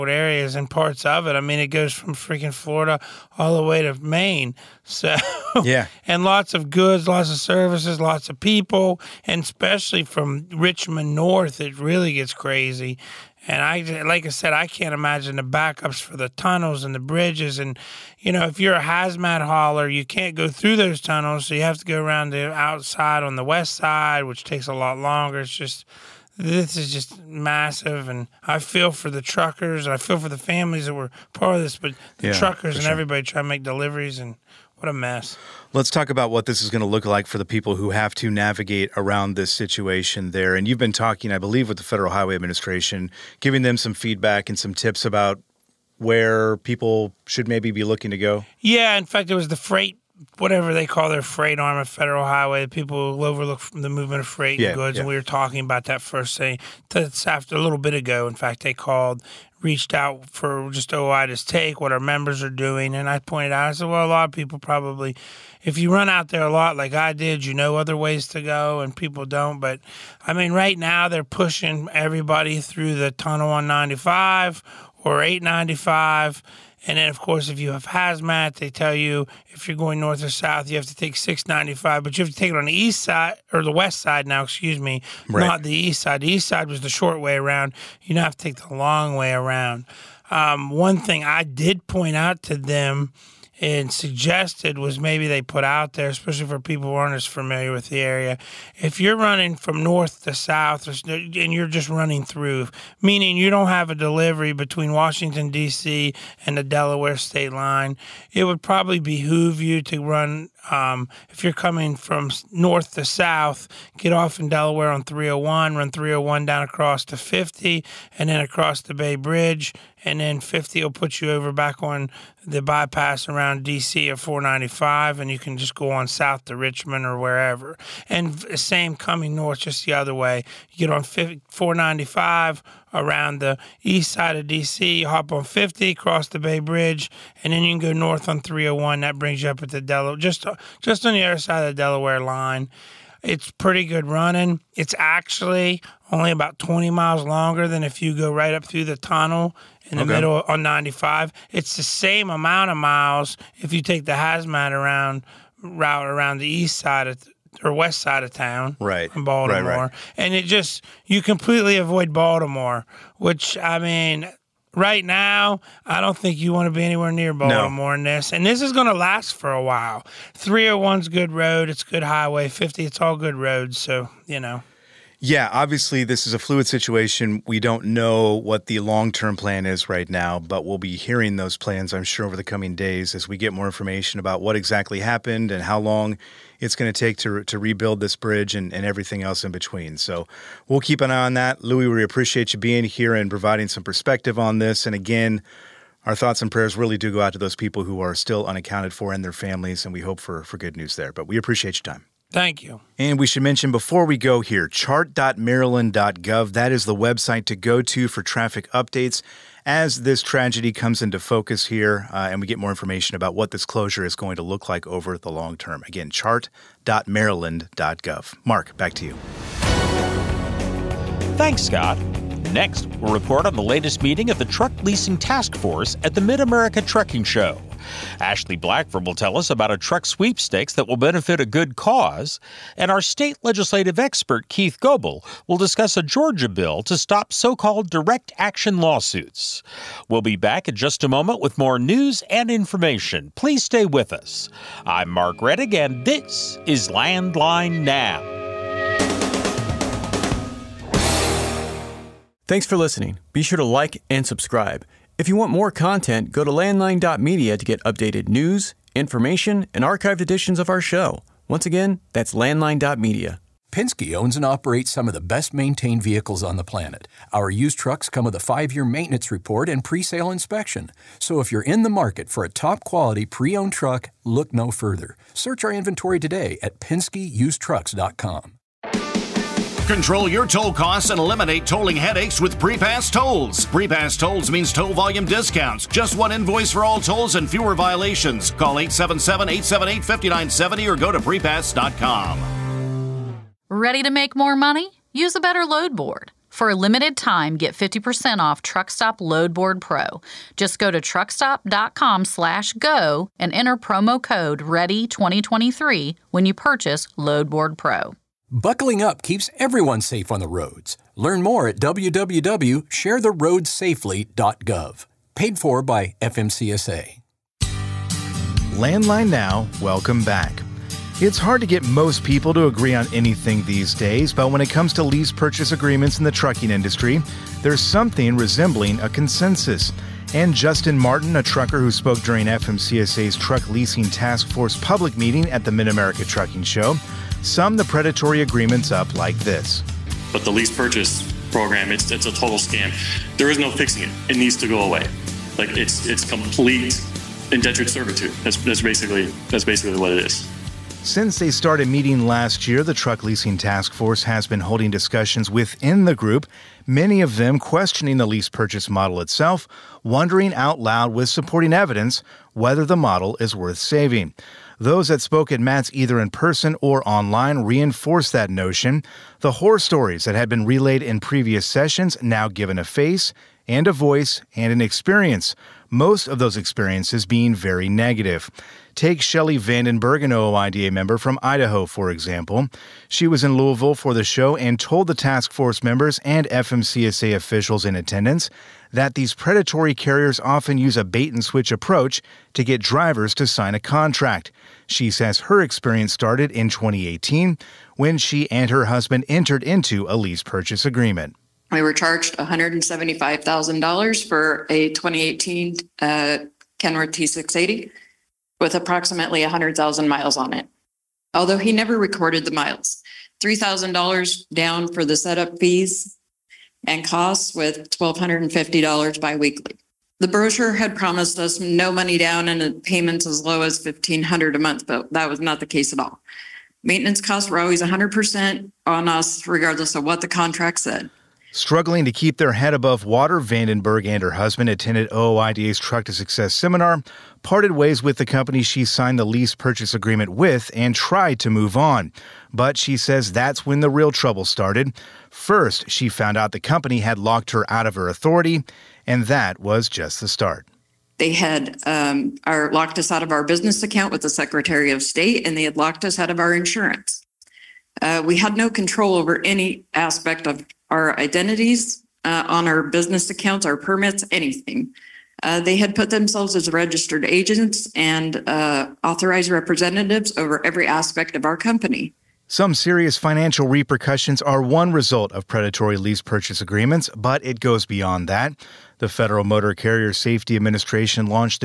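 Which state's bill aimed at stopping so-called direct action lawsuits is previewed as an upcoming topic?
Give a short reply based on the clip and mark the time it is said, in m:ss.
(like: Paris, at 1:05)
Georgia, at 3:56.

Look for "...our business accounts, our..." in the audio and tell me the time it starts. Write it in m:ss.
7:42.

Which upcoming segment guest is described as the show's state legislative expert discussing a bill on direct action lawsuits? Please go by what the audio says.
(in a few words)
Keith Goble.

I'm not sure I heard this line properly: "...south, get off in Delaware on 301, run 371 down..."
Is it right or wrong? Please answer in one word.
wrong.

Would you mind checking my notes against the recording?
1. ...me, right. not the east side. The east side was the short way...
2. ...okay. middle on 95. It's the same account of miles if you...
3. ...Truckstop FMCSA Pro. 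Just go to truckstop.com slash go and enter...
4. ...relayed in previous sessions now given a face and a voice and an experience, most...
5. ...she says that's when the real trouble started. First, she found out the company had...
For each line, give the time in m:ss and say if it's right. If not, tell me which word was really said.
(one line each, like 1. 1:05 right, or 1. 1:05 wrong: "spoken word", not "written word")
1. 1:24 right
2. 2:30 wrong: "amount", not "account"
3. 4:58 wrong: "Loadboard", not "FMCSA"
4. 6:10 right
5. 7:22 right.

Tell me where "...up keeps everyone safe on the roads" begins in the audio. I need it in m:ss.
5:09.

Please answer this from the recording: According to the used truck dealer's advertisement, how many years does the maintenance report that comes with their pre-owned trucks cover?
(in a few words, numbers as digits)
5.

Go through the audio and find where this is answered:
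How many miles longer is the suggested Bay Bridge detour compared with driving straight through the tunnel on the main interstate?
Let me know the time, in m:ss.
2:26.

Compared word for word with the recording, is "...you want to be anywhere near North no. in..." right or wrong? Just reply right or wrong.
wrong.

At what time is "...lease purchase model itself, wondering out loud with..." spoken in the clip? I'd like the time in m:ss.
5:58.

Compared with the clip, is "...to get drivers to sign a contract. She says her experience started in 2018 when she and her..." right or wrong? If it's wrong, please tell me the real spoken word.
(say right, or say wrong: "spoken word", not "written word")
right.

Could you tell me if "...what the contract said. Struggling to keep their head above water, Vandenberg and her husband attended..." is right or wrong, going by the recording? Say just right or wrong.
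right.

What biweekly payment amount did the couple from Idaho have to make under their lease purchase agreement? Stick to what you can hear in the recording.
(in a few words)
$1,250.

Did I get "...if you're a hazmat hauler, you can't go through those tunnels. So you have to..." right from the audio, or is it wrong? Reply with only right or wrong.
right.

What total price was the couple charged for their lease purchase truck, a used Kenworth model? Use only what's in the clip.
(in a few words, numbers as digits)
$175,000.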